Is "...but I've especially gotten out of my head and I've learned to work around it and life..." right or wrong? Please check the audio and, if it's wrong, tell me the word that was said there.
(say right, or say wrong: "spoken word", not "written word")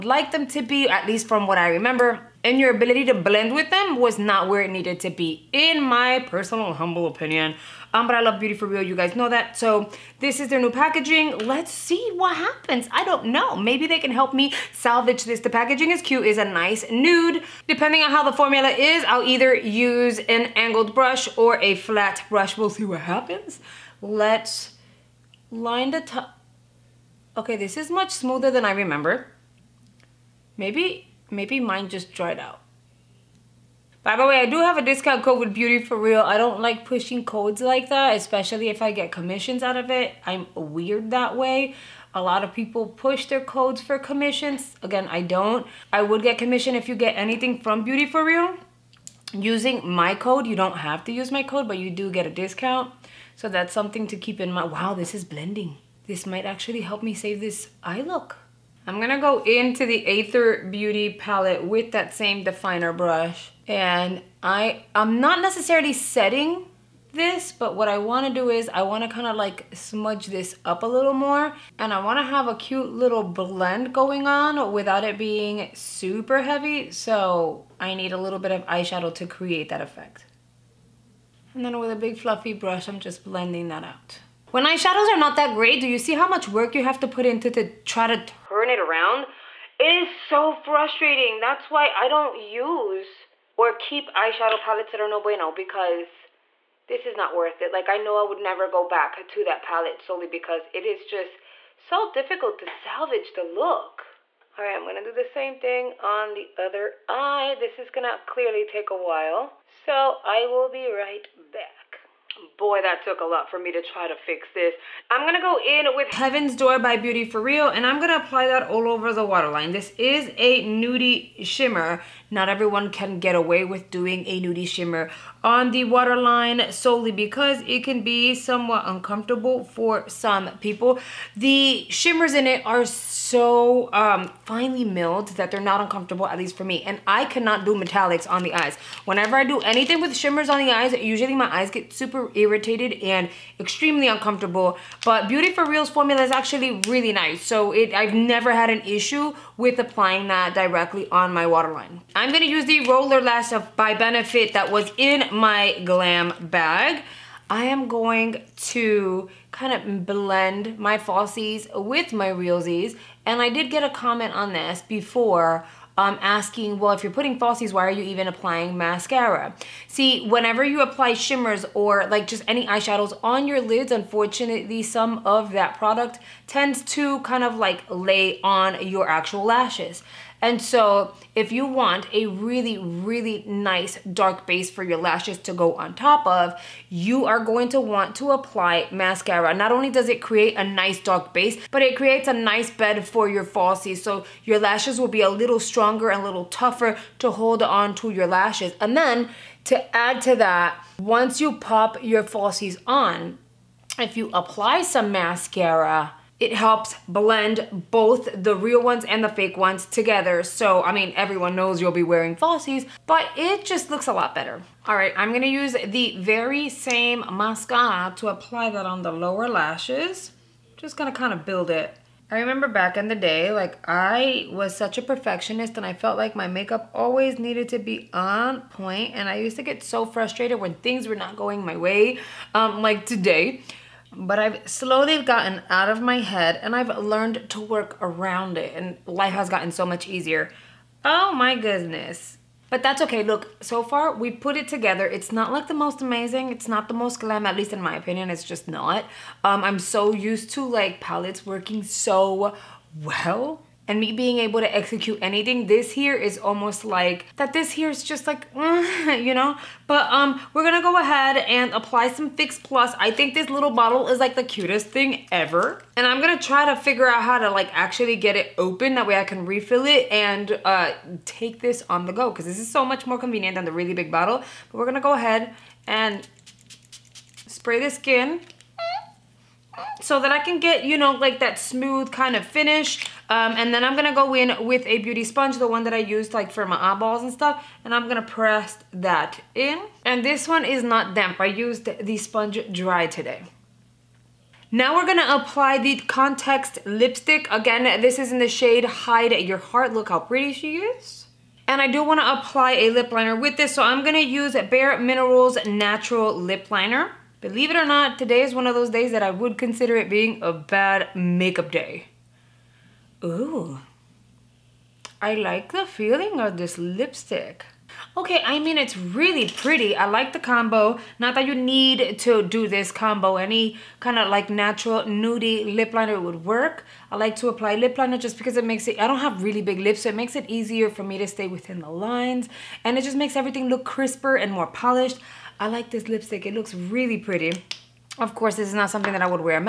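wrong: "slowly", not "especially".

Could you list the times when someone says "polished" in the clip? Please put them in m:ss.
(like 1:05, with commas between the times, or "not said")
5:34.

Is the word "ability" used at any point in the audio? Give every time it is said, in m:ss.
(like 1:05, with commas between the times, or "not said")
0:02.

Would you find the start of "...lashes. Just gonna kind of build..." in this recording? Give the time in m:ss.
3:39.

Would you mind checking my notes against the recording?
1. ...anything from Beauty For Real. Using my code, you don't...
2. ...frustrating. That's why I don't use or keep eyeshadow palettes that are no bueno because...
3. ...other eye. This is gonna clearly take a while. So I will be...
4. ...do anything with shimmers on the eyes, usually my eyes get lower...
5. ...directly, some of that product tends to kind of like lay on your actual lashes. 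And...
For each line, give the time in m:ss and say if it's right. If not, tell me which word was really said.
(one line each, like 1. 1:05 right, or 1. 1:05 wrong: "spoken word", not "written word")
1. 0:47 right
2. 1:30 right
3. 1:46 right
4. 2:19 wrong: "super", not "lower"
5. 2:53 wrong: "unfortunately", not "directly".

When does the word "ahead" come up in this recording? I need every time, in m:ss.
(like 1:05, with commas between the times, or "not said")
4:20, 4:35.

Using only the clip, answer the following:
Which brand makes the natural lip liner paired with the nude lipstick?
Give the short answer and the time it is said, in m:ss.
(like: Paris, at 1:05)
Bare Minerals, at 5:04.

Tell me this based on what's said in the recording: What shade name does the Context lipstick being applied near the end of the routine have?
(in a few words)
Hide Your Heart.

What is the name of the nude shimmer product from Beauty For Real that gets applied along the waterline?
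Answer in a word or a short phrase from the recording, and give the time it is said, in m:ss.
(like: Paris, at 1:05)
Heaven's Door, at 1:56.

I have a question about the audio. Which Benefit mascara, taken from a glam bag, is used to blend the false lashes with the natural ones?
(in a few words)
Roller lash.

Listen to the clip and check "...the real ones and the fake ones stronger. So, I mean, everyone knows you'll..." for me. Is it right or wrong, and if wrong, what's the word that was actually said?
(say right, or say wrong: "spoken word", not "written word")
wrong: "together", not "stronger".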